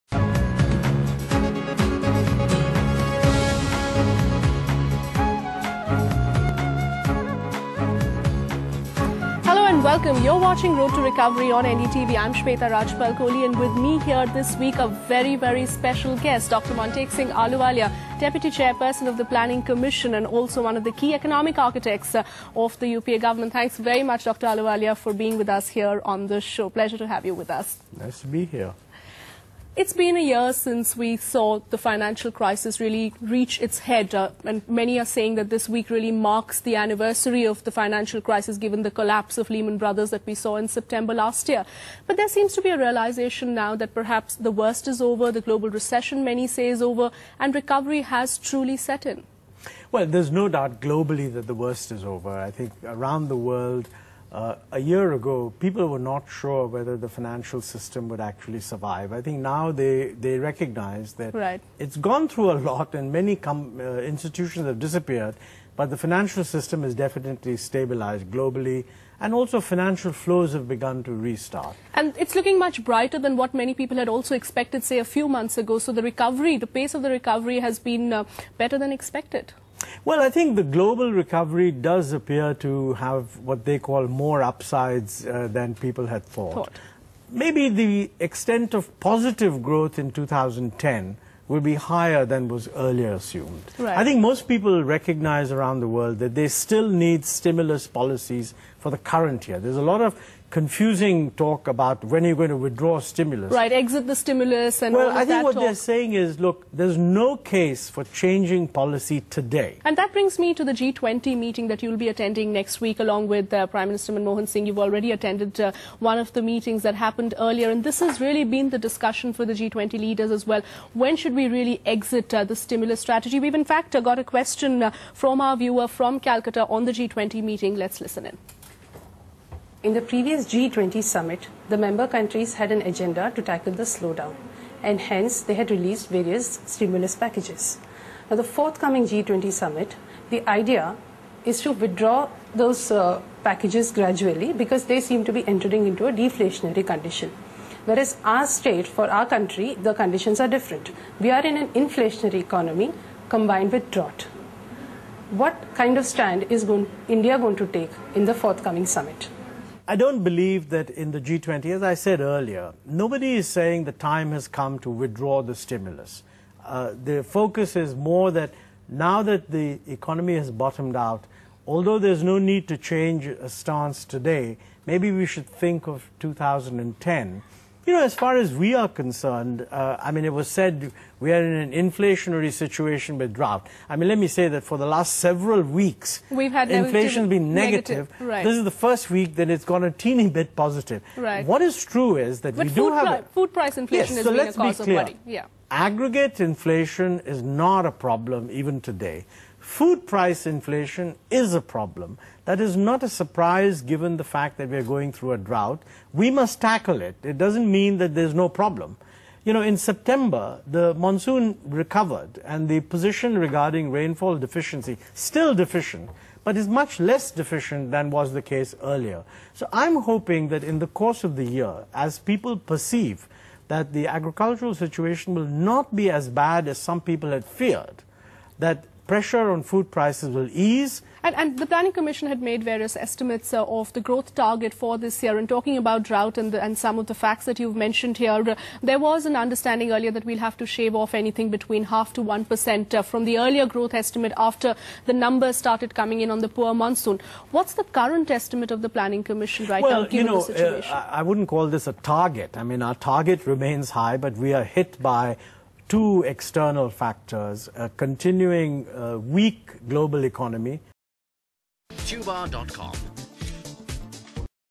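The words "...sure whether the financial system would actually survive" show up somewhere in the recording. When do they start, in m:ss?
0:56.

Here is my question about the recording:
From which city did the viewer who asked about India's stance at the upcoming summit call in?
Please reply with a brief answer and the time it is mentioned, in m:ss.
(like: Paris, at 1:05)
Calcutta, at 2:06.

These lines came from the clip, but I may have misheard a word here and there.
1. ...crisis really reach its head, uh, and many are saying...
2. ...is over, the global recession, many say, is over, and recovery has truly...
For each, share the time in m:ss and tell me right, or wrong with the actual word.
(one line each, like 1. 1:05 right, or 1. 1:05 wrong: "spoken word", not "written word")
1. 0:32 right
2. 0:44 right.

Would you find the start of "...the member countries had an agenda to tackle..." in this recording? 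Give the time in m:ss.
2:11.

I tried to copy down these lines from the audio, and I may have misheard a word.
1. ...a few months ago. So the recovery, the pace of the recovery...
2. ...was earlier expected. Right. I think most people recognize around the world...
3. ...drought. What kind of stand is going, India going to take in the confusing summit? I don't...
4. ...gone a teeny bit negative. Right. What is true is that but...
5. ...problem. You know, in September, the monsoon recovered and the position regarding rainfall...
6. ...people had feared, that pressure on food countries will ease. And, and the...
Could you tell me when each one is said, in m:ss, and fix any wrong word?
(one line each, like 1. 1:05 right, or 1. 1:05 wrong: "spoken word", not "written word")
1. 1:14 right
2. 1:32 wrong: "assumed", not "expected"
3. 2:33 wrong: "forthcoming", not "confusing"
4. 3:09 wrong: "positive", not "negative"
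5. 3:28 right
6. 3:47 wrong: "prices", not "countries".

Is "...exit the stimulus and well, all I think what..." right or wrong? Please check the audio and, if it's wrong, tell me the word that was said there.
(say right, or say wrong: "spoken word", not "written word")
right.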